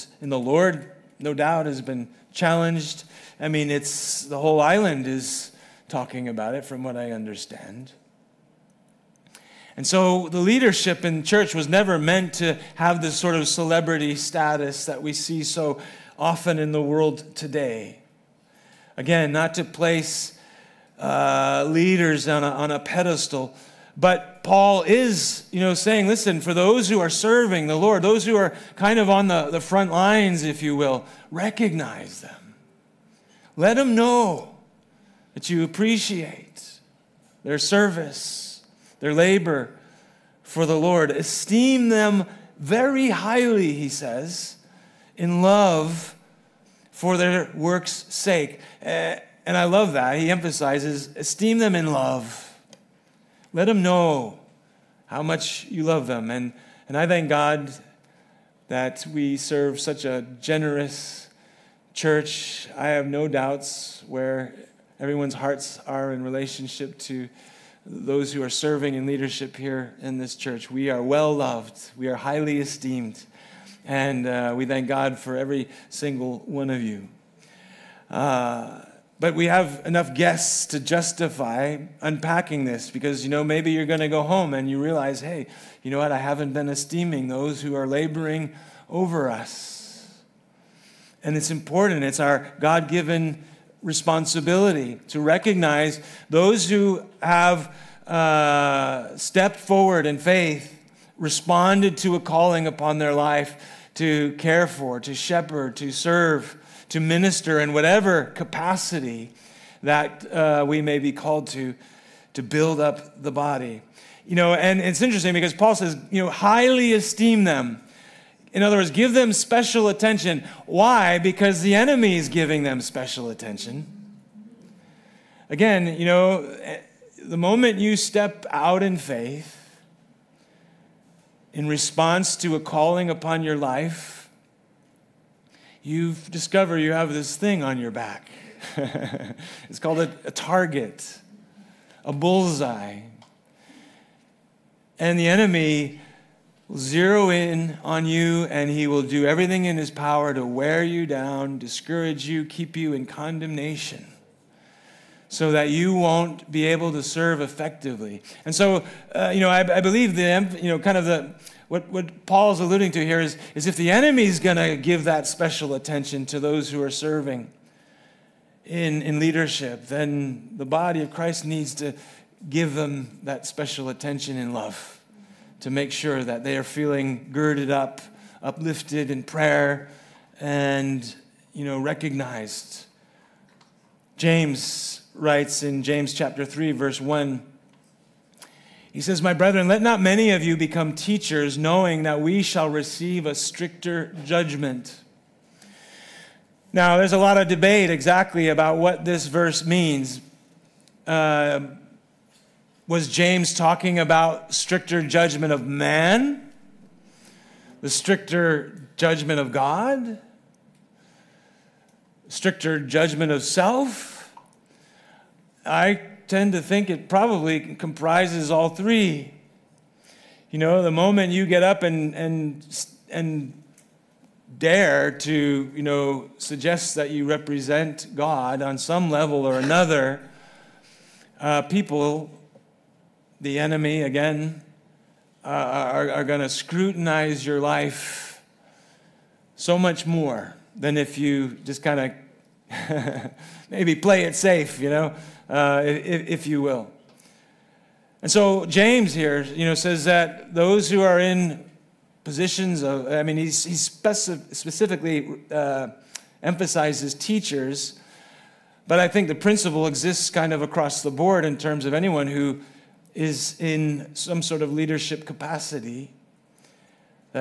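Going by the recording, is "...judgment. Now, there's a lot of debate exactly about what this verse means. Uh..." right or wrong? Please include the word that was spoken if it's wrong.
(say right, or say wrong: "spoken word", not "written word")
right.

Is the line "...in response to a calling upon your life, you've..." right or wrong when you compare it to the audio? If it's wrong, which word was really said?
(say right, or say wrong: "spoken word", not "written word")
right.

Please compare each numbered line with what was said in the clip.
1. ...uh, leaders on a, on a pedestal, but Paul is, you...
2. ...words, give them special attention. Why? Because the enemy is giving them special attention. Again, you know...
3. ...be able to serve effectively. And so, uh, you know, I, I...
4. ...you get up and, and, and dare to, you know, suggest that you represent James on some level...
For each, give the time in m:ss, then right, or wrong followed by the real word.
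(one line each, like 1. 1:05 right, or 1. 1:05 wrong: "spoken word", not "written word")
1. 0:20 right
2. 1:58 right
3. 2:36 right
4. 3:41 wrong: "God", not "James".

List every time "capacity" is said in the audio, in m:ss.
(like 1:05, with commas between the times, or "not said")
1:48, 4:25.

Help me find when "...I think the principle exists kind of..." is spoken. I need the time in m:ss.
4:18.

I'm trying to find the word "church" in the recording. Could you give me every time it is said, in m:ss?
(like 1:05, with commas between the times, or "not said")
0:11, 1:01, 1:10.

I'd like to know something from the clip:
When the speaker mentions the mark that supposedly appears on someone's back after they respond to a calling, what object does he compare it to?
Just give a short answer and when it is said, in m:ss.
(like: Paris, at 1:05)
A target, at 2:20.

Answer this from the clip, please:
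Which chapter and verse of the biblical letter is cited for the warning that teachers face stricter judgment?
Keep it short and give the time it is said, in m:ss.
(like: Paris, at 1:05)
Chapter 3, verse 1, at 3:06.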